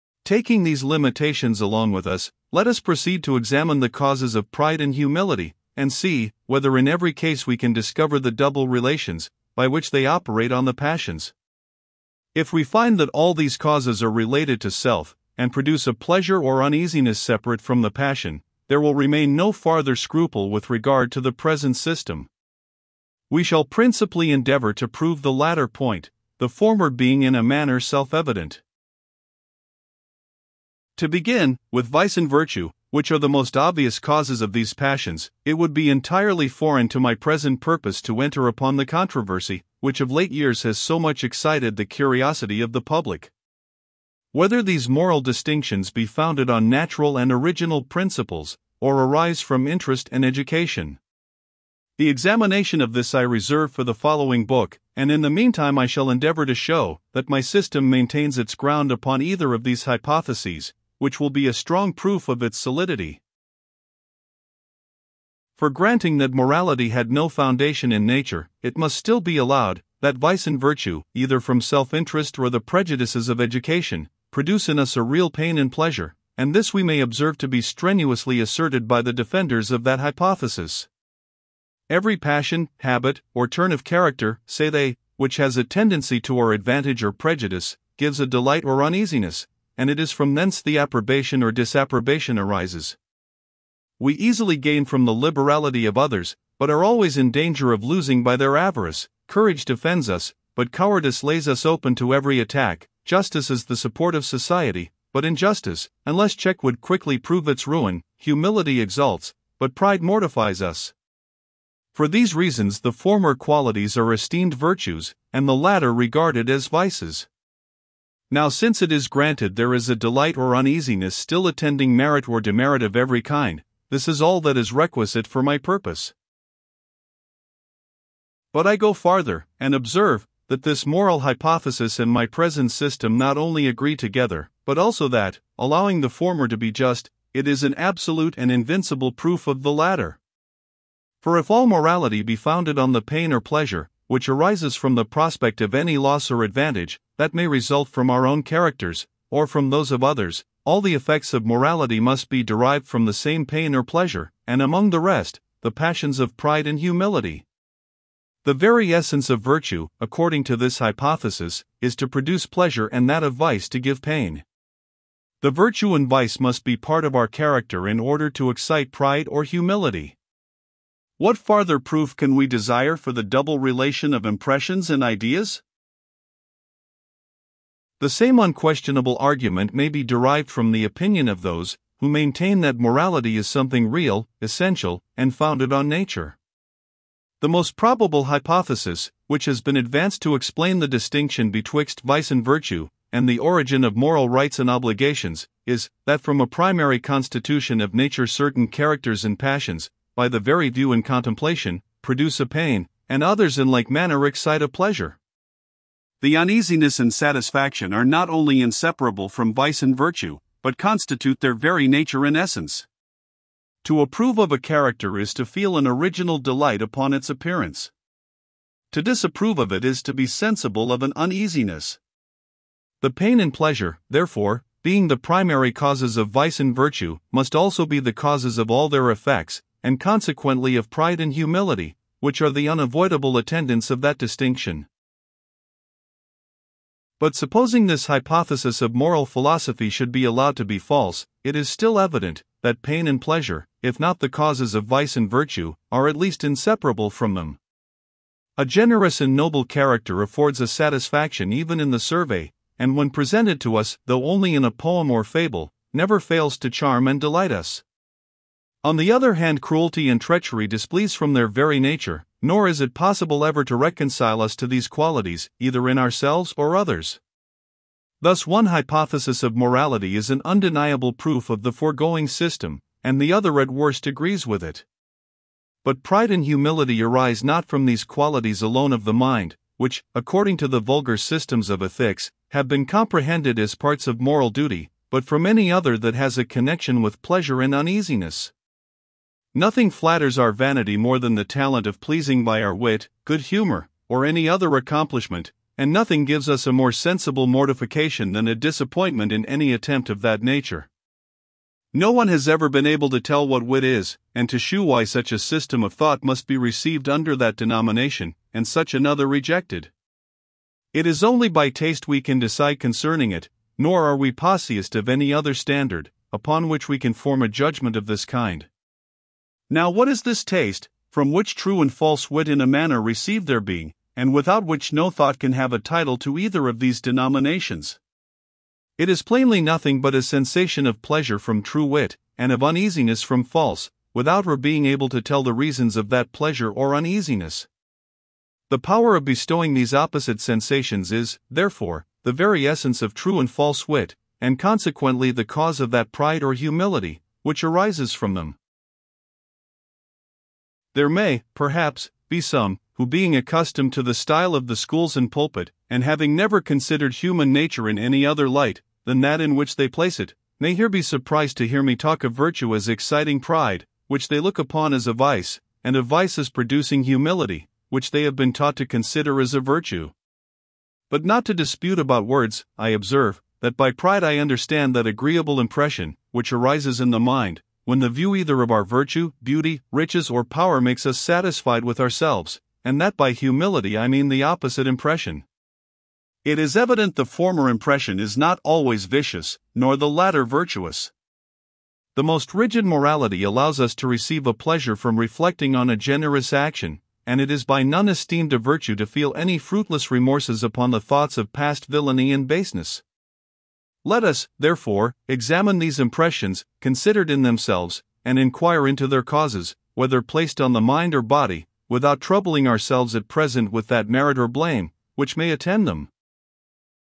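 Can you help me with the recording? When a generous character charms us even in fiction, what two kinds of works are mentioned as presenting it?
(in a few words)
a poem or fable.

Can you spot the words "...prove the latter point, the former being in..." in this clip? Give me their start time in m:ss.
0:24.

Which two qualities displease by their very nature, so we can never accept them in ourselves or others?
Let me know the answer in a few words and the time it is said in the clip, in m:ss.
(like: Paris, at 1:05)
cruelty and treachery, at 4:19.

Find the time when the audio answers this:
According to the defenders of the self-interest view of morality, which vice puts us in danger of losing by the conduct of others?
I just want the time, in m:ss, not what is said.
1:38.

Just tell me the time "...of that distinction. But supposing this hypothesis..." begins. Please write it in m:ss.
3:53.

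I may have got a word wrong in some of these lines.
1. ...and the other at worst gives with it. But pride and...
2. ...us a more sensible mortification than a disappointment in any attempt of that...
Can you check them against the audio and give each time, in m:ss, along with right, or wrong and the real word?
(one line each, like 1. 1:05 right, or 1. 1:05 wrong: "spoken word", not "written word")
1. 4:33 wrong: "agrees", not "gives"
2. 4:56 right.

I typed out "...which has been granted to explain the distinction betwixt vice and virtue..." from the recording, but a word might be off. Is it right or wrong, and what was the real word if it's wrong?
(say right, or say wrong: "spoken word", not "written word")
wrong: "advanced", not "granted".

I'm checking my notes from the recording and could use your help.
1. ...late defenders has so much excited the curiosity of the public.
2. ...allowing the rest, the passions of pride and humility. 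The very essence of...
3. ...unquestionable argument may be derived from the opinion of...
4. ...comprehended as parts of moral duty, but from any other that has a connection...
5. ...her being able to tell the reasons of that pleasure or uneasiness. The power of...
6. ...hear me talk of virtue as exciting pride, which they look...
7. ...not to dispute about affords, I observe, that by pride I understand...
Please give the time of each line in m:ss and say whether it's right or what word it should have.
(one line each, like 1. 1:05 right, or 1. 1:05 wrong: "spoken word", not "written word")
1. 0:40 wrong: "years", not "defenders"
2. 2:34 wrong: "among", not "allowing"
3. 2:58 right
4. 4:42 right
5. 5:34 right
6. 6:01 right
7. 6:11 wrong: "words", not "affords".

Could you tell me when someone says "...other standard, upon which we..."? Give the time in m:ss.
5:15.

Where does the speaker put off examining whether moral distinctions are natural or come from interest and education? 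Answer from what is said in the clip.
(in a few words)
the following book.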